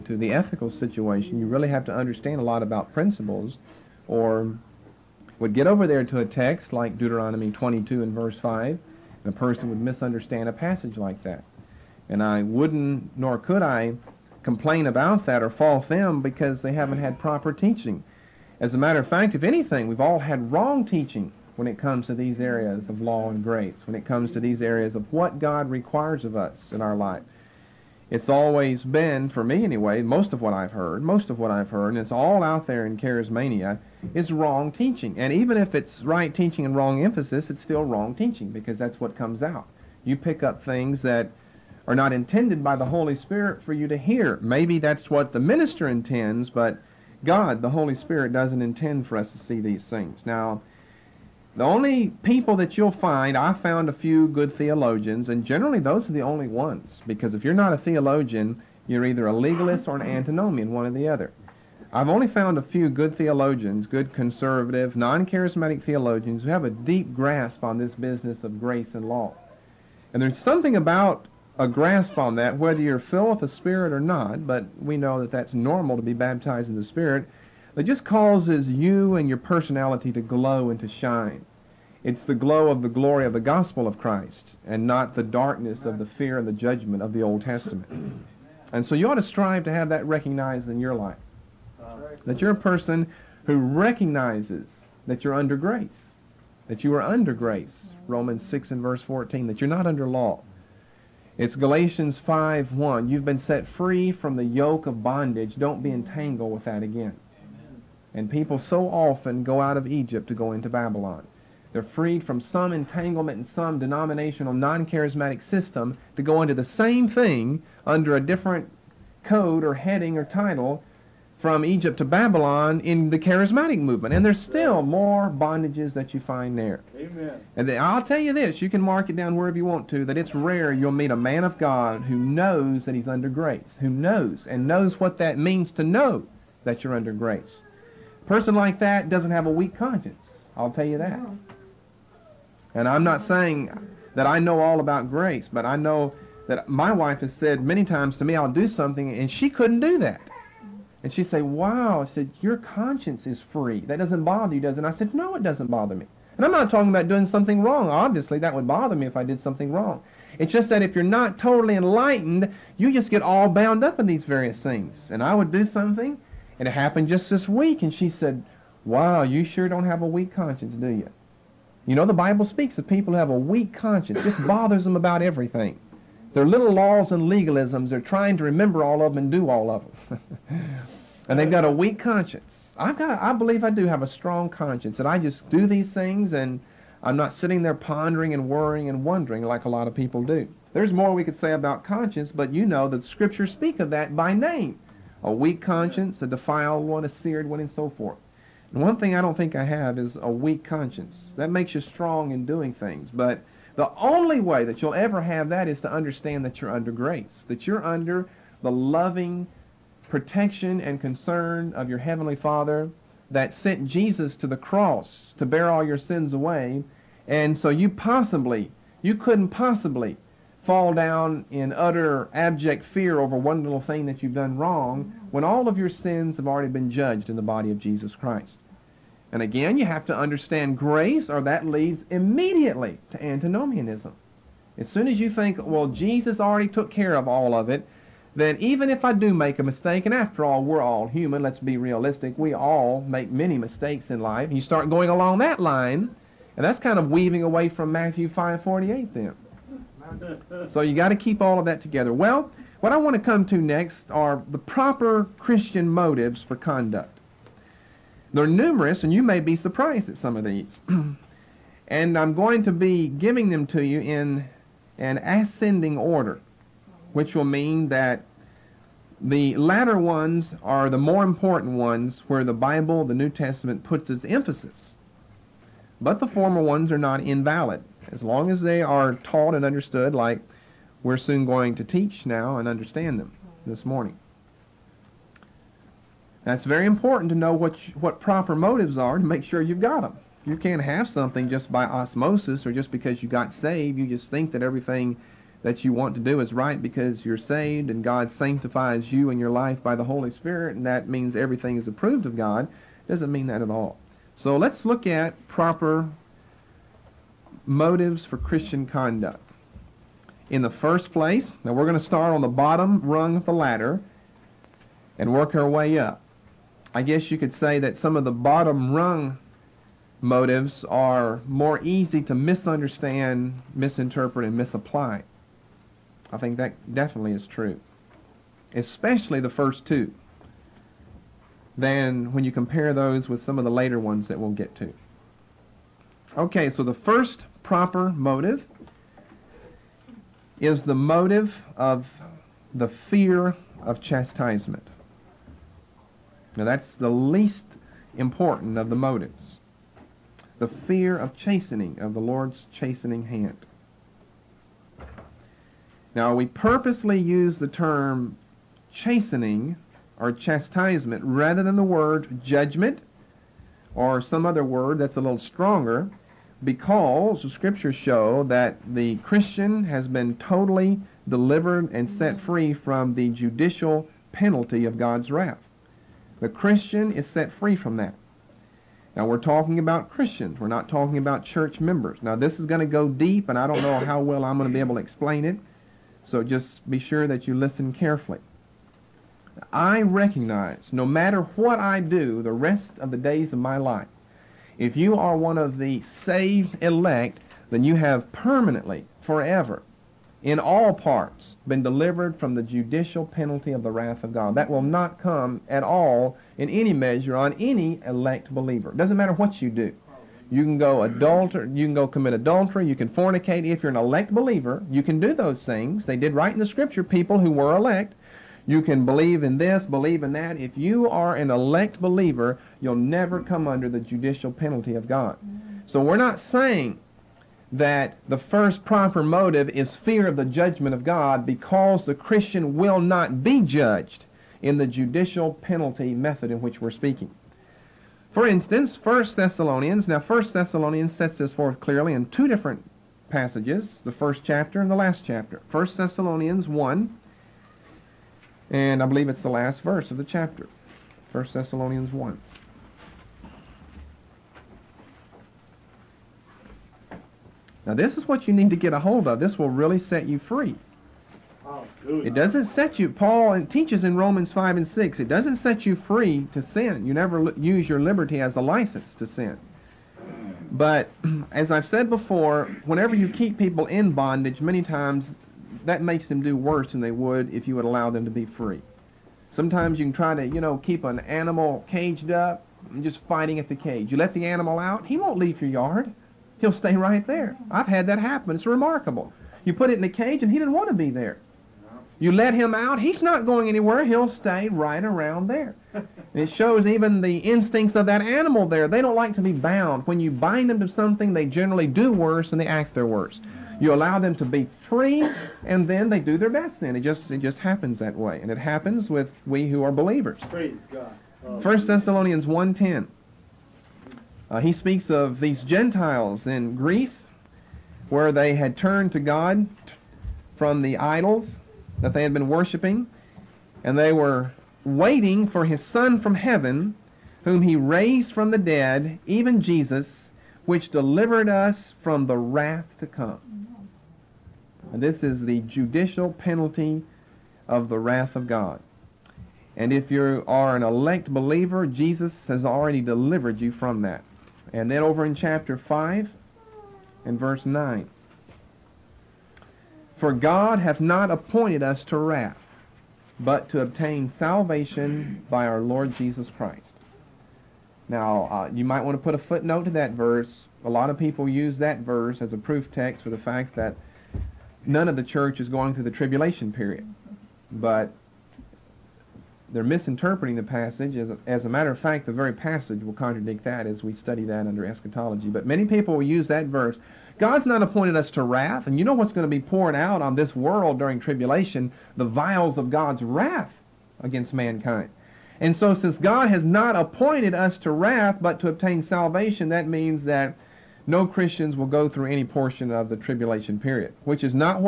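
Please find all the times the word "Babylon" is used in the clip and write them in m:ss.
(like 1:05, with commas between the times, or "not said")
1:50, 2:02.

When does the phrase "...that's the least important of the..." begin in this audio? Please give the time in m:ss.
5:46.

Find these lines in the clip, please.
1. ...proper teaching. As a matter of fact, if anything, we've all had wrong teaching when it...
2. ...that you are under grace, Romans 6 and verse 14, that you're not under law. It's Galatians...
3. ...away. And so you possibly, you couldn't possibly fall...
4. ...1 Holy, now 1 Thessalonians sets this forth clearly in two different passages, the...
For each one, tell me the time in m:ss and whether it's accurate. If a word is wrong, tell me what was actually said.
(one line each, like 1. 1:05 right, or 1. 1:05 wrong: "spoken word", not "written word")
1. 0:17 right
2. 1:36 right
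3. 3:36 right
4. 7:19 wrong: "Thessalonians", not "Holy".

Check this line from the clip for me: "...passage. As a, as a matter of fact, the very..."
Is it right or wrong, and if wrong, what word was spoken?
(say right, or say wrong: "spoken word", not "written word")
right.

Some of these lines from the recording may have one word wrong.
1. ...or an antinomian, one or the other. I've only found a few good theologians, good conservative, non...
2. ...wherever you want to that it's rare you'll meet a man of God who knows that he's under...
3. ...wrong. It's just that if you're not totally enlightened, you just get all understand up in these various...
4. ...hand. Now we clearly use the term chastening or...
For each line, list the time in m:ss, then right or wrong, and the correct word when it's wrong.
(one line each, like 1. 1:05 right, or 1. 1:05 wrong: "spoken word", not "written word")
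1. 0:59 right
2. 2:09 right
3. 2:39 wrong: "bound", not "understand"
4. 5:53 wrong: "purposely", not "clearly".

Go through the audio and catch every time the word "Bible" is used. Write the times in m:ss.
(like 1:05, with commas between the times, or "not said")
2:52, 4:32.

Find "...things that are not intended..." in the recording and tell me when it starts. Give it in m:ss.
0:40.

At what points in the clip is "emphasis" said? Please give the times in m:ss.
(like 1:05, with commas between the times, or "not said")
0:37, 4:34.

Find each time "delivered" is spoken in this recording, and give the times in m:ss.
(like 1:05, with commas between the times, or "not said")
6:11, 6:41, 8:50, 9:03.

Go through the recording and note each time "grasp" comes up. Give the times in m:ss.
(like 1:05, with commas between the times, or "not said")
1:07, 1:11.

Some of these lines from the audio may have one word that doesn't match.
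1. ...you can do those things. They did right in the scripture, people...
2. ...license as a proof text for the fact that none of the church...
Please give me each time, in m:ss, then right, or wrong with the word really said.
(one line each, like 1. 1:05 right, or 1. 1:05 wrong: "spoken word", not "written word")
1. 6:54 right
2. 9:22 wrong: "verse", not "license".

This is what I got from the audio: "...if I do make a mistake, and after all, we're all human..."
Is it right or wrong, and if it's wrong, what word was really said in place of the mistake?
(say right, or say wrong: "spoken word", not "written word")
right.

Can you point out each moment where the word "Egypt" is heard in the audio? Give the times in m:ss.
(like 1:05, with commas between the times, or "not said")
1:49, 2:01.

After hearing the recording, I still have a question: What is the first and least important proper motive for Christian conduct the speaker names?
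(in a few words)
Fear of chastisement.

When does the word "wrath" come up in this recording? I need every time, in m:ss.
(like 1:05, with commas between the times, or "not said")
6:15, 6:43, 8:52, 8:57, 9:12, 9:38, 9:43, 9:47.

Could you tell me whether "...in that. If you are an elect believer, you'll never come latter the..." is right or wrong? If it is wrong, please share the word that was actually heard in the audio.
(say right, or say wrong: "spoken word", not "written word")
wrong: "under", not "latter".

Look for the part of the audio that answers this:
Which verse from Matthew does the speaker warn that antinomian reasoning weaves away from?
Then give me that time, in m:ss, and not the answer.
4:07.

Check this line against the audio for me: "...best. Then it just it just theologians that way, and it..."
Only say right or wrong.
wrong.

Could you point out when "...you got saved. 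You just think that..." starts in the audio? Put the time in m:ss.
4:53.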